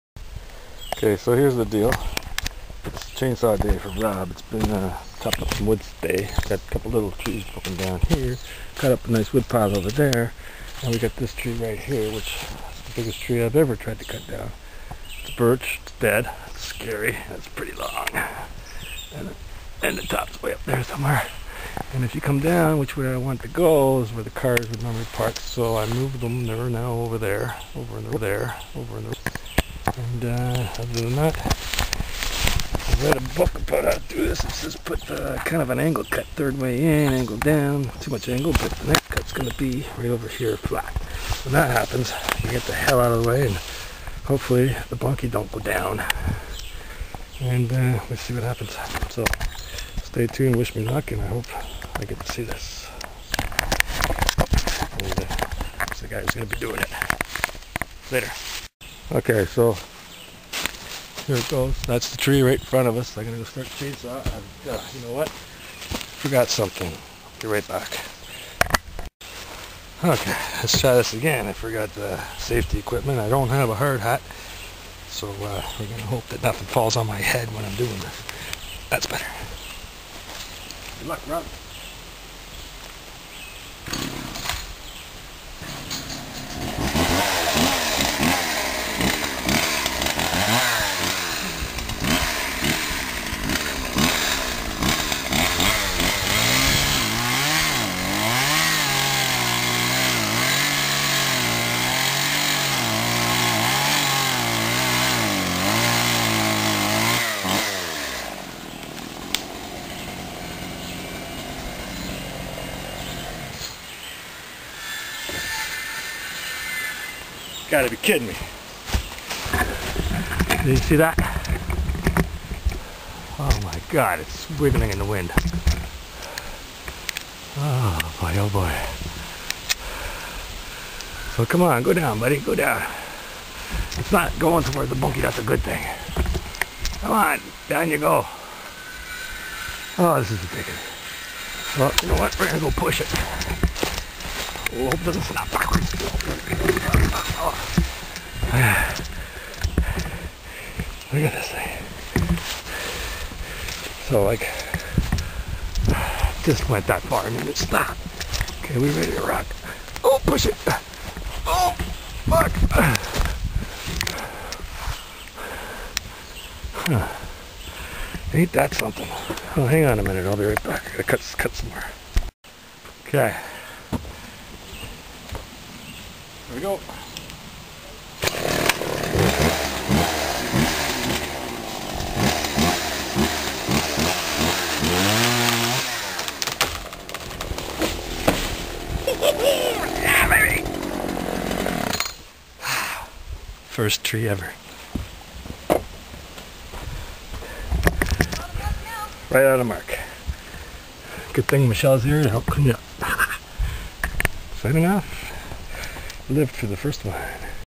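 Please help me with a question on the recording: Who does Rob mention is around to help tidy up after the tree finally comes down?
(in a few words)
Michelle.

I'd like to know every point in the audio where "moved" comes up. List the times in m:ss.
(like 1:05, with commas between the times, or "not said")
0:25.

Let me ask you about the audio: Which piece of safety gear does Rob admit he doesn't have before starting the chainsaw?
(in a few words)
Hard hat.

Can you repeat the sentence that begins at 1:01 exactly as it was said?
That's the tree right in front of us.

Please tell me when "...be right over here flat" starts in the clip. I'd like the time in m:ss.
0:39.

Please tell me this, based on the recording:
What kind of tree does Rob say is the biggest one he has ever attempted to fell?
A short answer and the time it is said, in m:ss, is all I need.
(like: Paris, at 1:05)
Birch, at 0:15.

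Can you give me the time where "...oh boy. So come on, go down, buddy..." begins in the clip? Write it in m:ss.
2:08.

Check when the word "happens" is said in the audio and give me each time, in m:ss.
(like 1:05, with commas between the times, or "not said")
0:41, 0:48.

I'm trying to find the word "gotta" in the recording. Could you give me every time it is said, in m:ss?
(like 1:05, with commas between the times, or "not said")
1:57, 2:50.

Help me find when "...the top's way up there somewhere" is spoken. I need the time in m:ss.
0:19.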